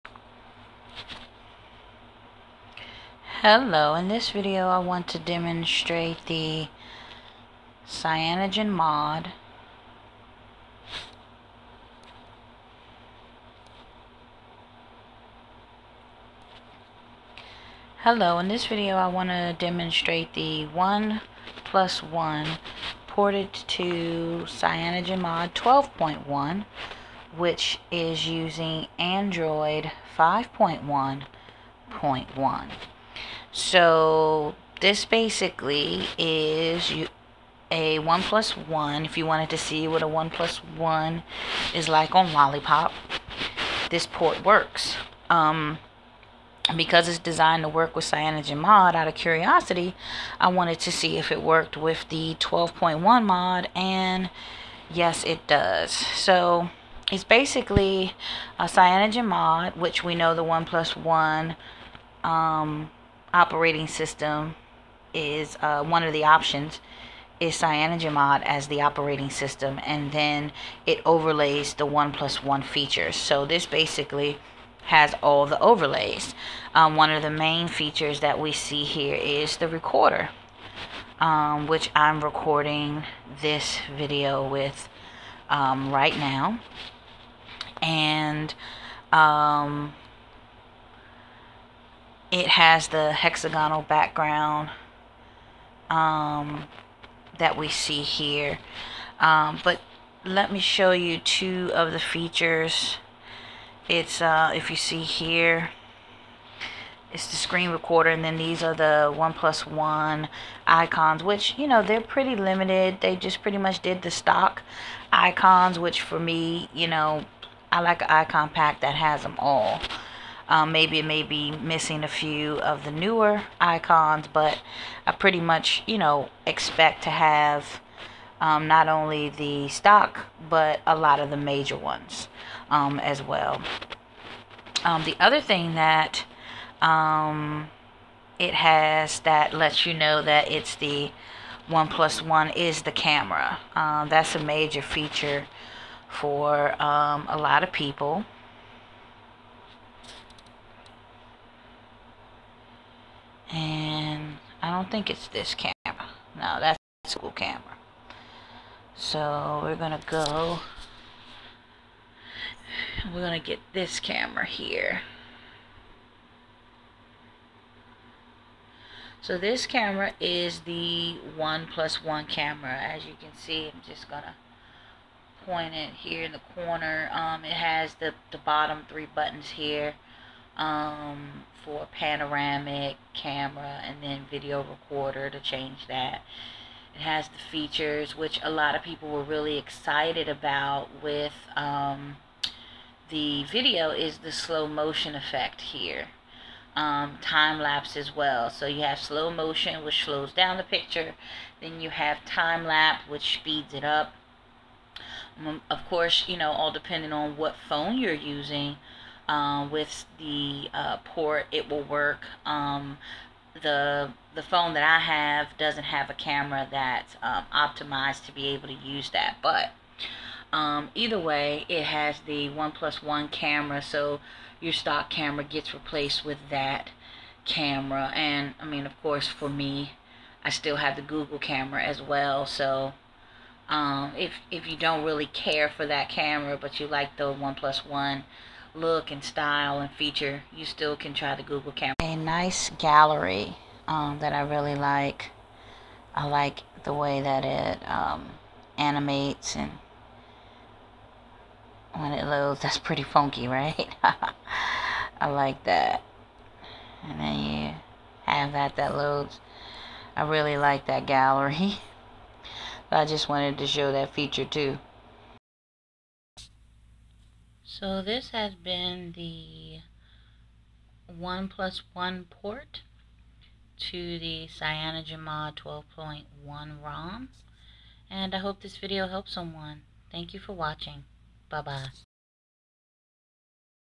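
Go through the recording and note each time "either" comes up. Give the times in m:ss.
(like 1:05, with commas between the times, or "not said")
3:40.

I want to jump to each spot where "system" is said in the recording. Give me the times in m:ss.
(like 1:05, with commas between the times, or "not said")
1:03, 1:09.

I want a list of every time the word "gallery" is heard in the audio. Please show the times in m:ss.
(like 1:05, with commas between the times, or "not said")
4:02, 4:21.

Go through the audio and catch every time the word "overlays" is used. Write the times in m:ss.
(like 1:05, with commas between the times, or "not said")
1:11, 1:15.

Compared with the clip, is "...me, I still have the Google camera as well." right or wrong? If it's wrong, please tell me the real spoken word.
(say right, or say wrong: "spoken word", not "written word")
right.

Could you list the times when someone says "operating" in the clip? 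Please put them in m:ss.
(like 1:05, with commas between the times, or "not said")
1:03, 1:08.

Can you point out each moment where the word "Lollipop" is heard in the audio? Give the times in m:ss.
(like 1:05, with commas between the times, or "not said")
0:42.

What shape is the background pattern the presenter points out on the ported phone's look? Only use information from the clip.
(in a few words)
Hexagonal.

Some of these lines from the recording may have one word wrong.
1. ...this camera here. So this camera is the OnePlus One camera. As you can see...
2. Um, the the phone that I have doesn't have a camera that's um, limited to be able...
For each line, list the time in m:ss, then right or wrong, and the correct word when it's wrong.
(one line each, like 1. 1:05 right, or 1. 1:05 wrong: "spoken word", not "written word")
1. 2:43 right
2. 3:32 wrong: "optimized", not "limited".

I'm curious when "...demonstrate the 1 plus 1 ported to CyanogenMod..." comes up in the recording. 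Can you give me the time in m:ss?
0:19.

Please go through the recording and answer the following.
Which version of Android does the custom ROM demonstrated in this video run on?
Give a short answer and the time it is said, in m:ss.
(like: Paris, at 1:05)
5.1.1, at 0:28.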